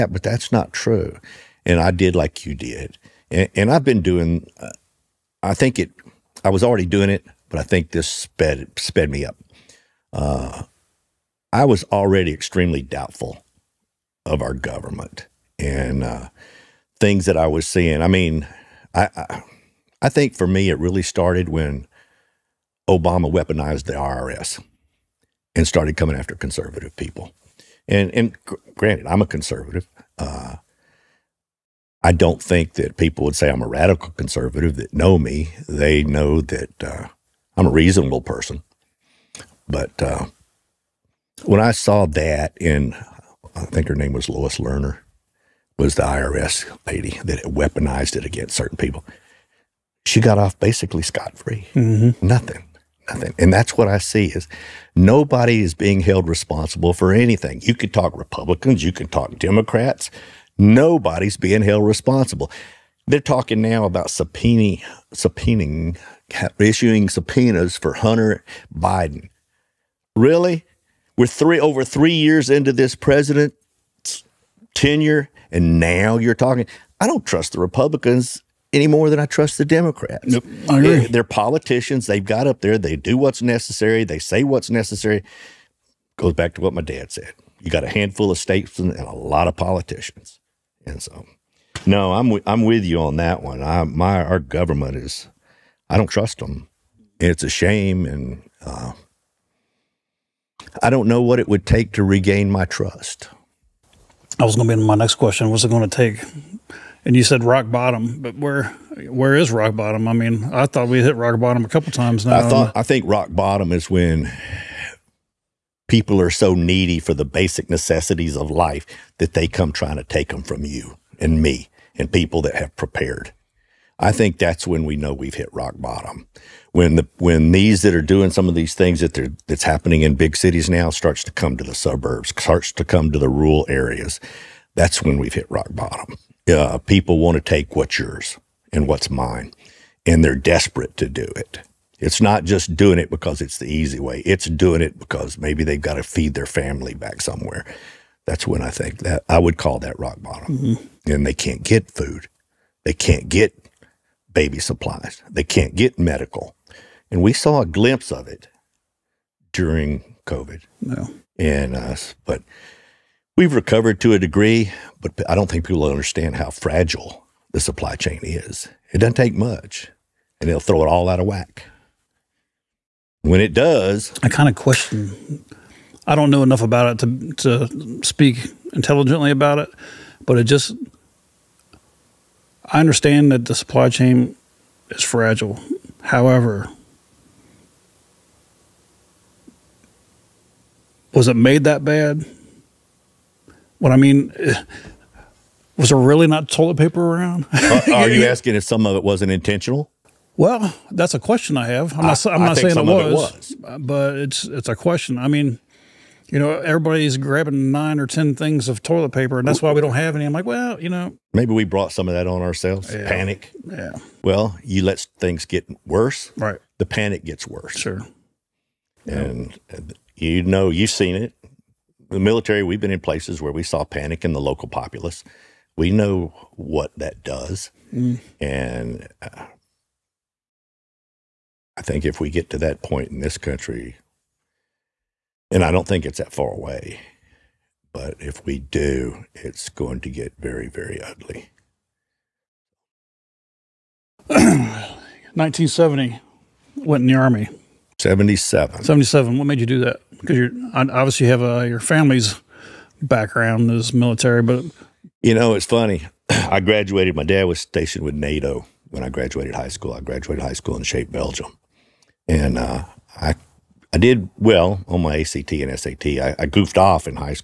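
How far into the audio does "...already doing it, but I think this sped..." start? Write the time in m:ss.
0:06.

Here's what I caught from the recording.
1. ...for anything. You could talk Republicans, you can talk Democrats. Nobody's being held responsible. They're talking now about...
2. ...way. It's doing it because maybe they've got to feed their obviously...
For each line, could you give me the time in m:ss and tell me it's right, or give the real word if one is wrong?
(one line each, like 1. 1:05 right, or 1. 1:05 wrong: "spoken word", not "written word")
1. 0:56 right
2. 2:23 wrong: "family", not "obviously".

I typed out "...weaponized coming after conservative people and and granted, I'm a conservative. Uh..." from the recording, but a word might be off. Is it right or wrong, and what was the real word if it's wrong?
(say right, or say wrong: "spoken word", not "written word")
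wrong: "started", not "weaponized".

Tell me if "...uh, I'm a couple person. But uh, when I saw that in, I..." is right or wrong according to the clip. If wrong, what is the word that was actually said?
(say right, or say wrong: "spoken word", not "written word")
wrong: "reasonable", not "couple".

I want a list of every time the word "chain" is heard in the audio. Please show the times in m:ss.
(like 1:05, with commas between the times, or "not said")
2:47, 3:03.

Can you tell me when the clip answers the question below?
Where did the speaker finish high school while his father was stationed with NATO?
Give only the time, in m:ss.
4:20.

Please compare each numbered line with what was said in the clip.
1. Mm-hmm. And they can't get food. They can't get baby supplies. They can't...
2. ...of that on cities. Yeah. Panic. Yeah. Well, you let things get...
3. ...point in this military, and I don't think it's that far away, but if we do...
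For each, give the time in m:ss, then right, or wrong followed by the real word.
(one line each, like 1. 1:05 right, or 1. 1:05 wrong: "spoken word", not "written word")
1. 2:30 right
2. 3:32 wrong: "ourselves", not "cities"
3. 3:52 wrong: "country", not "military".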